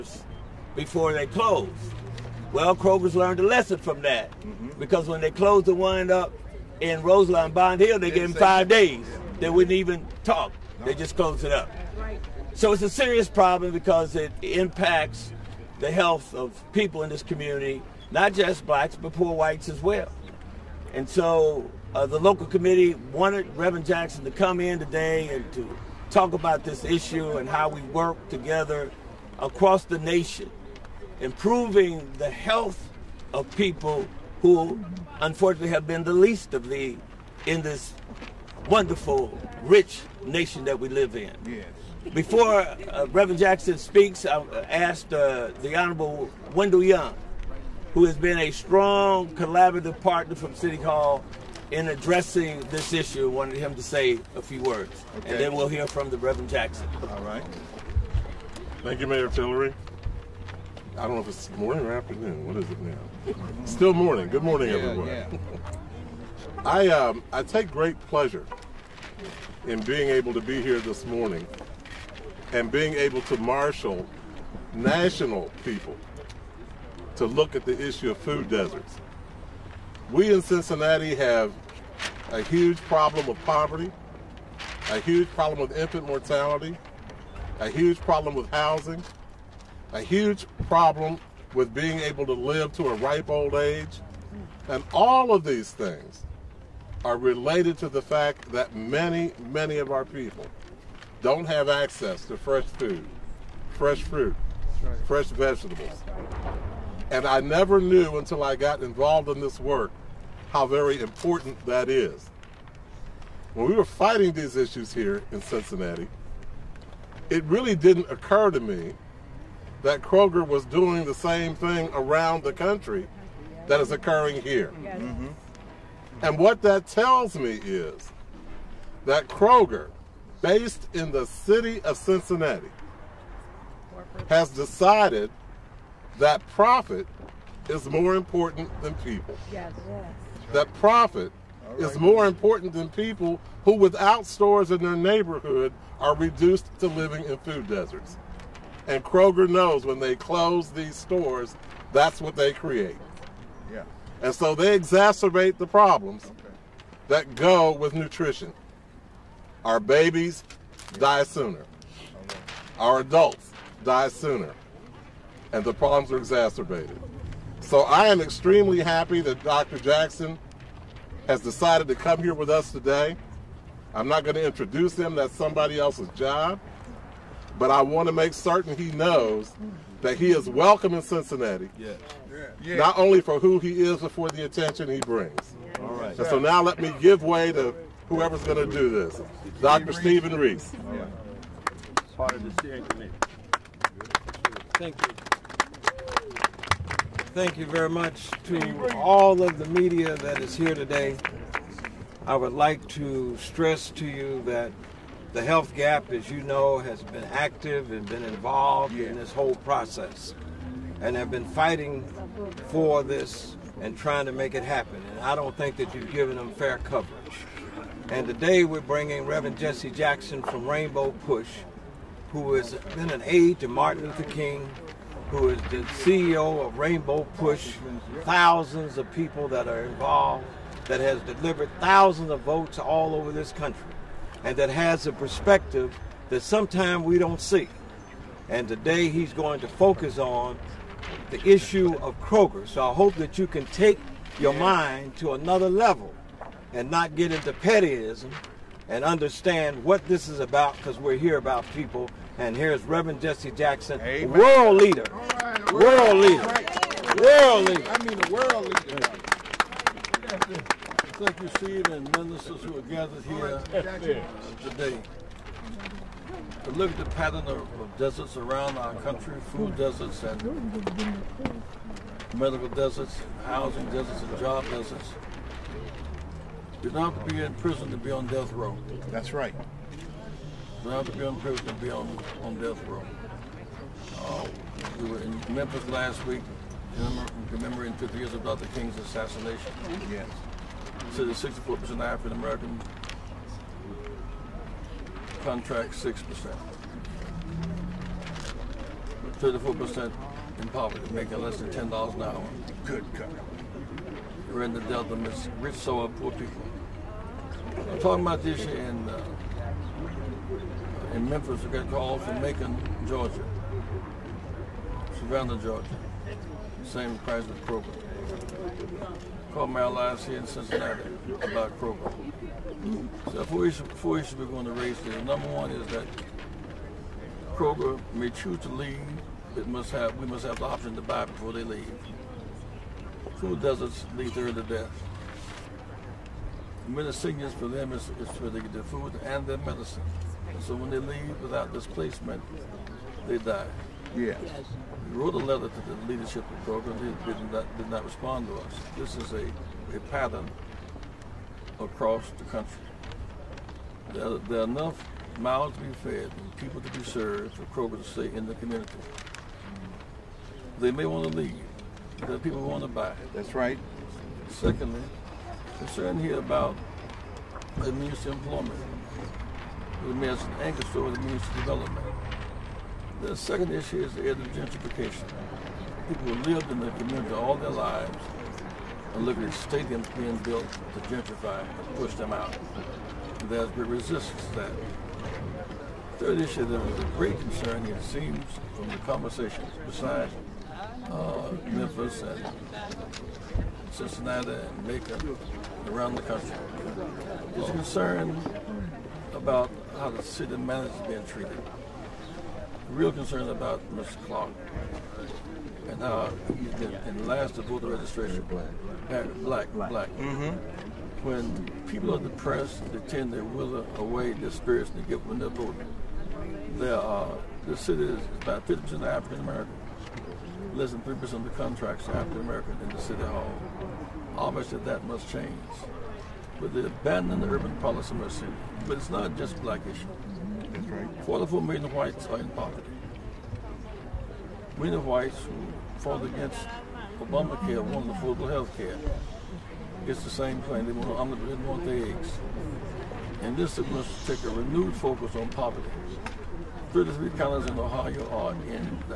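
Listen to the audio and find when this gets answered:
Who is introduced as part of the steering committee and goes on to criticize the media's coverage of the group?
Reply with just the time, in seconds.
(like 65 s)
189 s.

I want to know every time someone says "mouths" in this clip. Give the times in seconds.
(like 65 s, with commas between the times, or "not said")
355 s.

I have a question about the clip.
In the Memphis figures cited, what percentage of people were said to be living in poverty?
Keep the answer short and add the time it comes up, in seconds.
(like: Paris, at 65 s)
34%, at 299 s.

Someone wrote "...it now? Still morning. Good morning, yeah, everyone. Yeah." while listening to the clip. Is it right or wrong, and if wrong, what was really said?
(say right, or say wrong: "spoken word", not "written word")
right.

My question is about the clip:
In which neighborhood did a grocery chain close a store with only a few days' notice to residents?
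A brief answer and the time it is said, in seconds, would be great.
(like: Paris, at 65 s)
Roselawn Bond Hill, at 7 s.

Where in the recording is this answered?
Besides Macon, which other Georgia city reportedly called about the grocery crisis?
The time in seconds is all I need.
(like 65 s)
315 s.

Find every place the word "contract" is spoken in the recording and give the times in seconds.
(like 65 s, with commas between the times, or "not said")
295 s, 421 s.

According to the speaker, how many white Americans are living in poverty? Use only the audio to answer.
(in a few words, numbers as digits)
44 million.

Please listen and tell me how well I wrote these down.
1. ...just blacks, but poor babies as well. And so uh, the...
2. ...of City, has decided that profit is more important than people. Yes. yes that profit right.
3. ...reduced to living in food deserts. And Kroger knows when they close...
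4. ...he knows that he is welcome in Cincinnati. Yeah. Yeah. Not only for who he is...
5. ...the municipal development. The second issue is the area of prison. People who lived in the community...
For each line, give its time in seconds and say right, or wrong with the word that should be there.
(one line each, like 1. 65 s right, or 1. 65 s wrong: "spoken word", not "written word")
1. 18 s wrong: "whites", not "babies"
2. 131 s wrong: "Cincinnati", not "City"
3. 146 s right
4. 178 s right
5. 371 s wrong: "gentrification", not "prison".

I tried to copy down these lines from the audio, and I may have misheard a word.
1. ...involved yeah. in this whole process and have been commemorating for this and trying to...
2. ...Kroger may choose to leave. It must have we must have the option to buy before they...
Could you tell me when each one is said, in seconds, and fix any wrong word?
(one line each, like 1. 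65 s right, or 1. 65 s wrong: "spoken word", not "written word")
1. 208 s wrong: "fighting", not "commemorating"
2. 327 s right.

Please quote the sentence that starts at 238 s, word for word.
And today he's going to focus on the issue of Kroger.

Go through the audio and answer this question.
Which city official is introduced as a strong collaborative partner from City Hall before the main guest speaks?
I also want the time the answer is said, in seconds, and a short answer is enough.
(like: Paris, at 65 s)
Wendell Young, at 46 s.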